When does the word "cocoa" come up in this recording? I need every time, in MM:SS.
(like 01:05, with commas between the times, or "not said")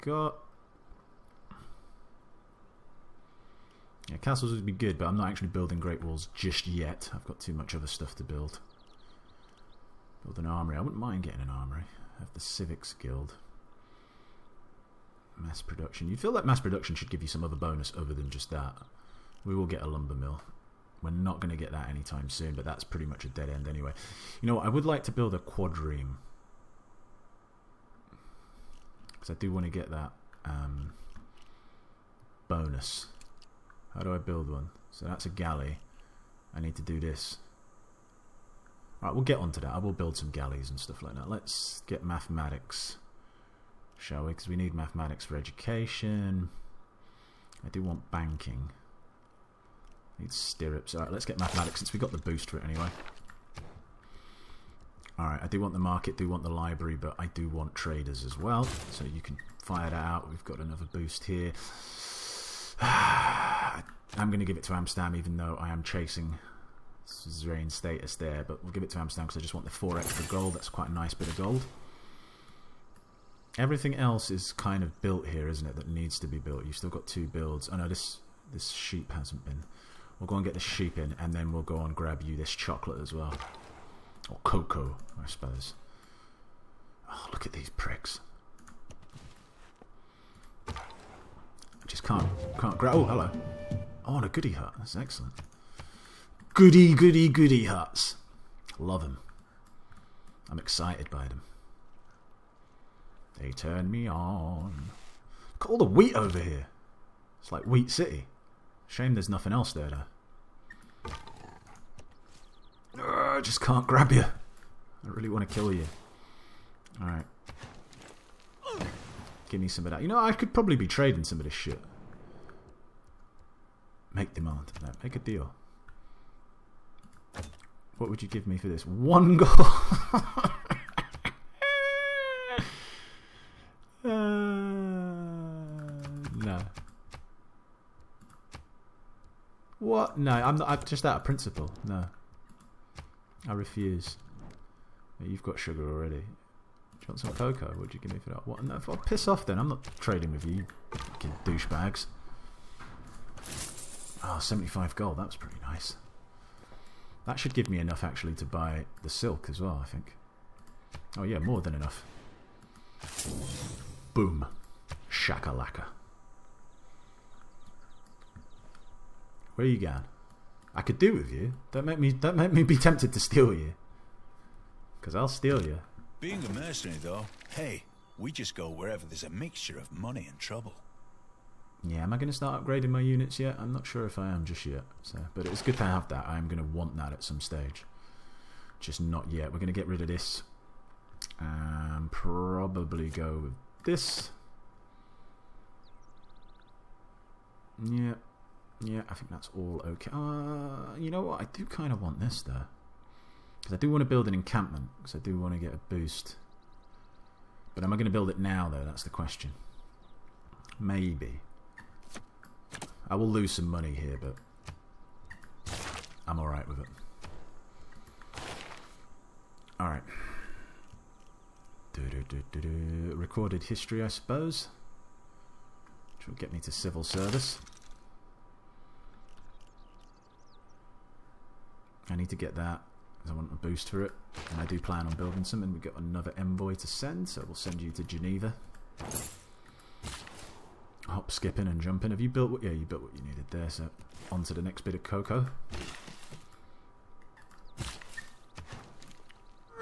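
01:24, 02:27, 04:05.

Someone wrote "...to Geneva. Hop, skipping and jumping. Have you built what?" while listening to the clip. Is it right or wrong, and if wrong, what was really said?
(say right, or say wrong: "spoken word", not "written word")
right.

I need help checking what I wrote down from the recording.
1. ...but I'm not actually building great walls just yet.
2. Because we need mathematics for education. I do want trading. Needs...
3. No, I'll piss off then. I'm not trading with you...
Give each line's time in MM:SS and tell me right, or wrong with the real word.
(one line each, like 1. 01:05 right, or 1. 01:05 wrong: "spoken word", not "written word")
1. 00:04 right
2. 00:44 wrong: "banking", not "trading"
3. 02:28 right.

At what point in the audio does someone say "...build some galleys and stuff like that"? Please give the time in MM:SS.
00:39.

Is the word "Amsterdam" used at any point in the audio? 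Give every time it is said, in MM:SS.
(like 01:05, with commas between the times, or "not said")
01:04, 01:08.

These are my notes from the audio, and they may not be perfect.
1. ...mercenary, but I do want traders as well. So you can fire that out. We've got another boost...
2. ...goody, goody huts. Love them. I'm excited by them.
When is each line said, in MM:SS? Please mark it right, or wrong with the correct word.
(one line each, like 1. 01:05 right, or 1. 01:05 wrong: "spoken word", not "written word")
1. 00:56 wrong: "library", not "mercenary"
2. 01:36 right.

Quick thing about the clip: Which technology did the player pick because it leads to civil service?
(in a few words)
Recorded history.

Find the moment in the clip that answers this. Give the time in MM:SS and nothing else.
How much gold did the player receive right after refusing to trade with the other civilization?
02:34.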